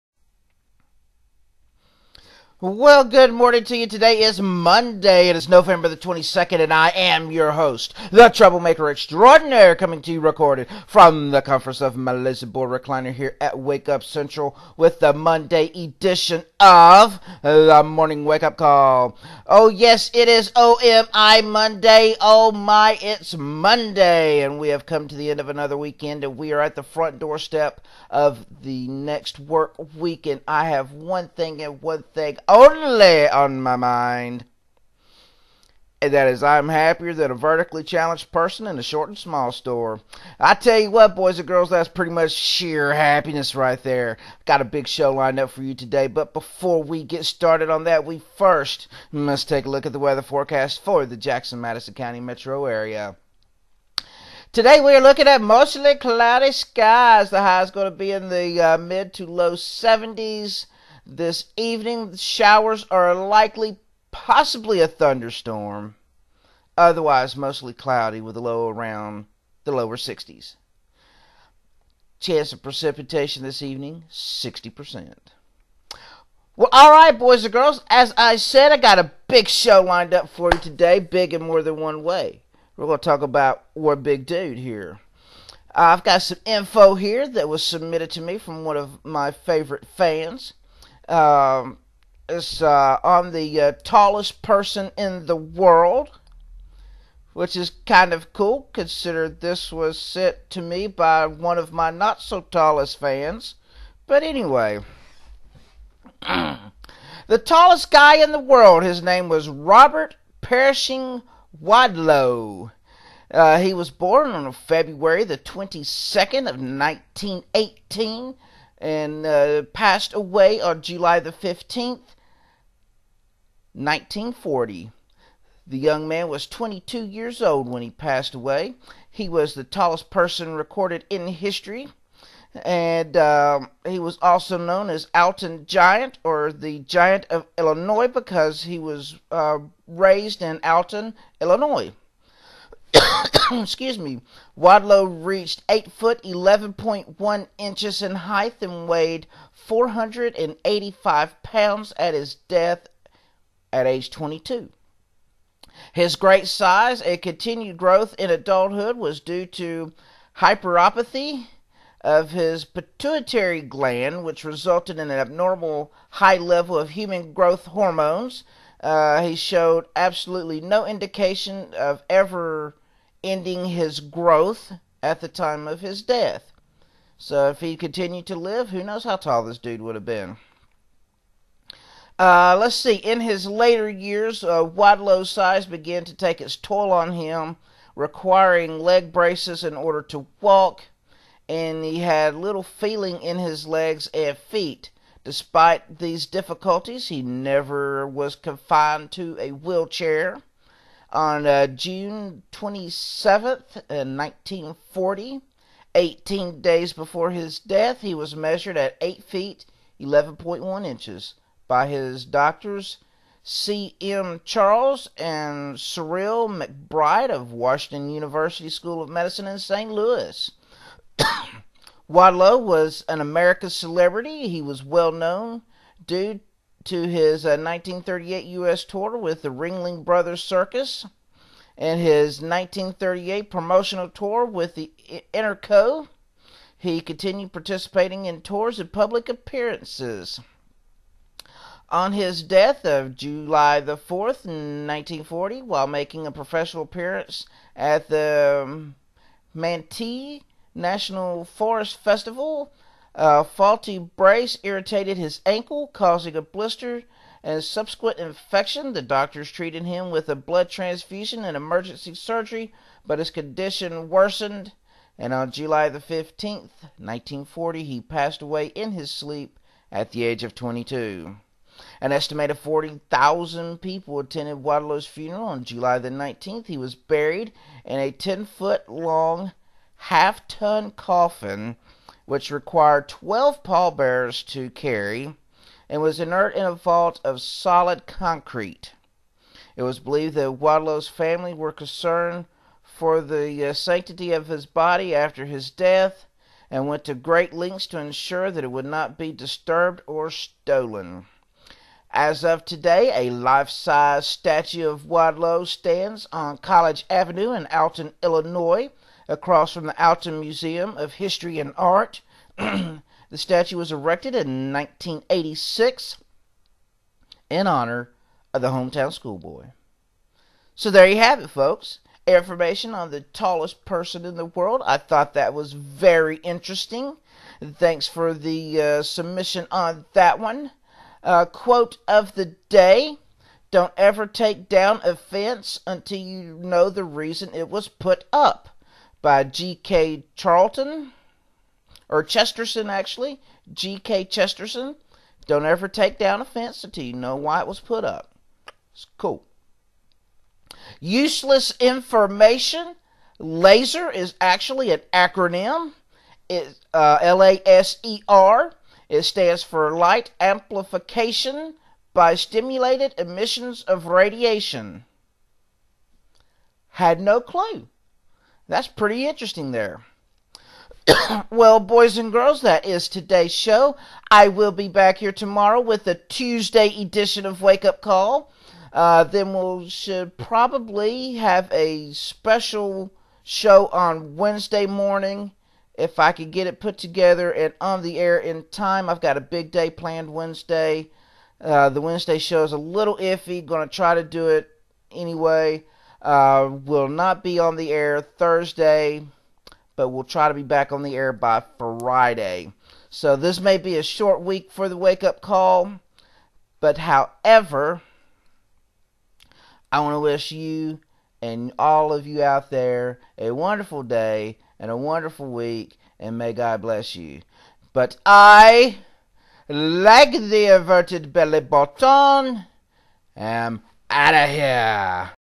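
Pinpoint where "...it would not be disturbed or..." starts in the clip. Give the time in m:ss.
4:58.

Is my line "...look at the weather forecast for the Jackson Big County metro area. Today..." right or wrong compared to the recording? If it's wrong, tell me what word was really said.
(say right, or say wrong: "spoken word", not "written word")
wrong: "Madison", not "Big".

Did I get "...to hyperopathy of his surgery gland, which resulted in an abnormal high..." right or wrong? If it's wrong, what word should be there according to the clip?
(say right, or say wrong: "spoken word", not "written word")
wrong: "pituitary", not "surgery".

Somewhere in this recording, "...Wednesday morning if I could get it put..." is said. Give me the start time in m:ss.
6:24.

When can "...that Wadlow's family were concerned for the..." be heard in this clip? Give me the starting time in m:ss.
4:50.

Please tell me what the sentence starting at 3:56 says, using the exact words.
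He continued participating in tours and public appearances.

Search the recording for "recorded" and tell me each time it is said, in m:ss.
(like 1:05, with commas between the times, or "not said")
0:10, 2:10.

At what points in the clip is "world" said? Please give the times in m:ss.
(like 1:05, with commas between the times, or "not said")
1:35, 1:48, 5:24.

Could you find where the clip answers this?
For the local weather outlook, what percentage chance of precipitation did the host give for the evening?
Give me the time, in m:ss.
1:14.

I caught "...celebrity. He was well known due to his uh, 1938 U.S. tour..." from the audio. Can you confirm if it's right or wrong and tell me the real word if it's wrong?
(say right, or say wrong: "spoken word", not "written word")
right.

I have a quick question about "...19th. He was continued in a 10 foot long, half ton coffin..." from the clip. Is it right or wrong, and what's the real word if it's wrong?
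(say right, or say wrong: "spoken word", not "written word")
wrong: "buried", not "continued".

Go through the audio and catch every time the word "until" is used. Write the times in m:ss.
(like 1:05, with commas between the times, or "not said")
5:35, 5:46.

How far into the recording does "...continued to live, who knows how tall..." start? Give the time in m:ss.
2:57.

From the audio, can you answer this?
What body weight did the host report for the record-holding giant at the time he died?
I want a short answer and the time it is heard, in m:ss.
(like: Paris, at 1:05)
485 pounds, at 2:29.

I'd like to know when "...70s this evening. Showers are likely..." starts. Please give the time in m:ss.
0:59.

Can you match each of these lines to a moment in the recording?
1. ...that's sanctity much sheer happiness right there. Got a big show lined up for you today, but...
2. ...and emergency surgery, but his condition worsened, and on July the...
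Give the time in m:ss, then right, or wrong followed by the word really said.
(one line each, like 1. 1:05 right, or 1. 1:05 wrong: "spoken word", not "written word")
1. 0:41 wrong: "pretty", not "sanctity"
2. 4:21 right.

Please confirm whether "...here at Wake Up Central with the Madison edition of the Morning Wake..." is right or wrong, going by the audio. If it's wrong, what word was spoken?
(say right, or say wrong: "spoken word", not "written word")
wrong: "Monday", not "Madison".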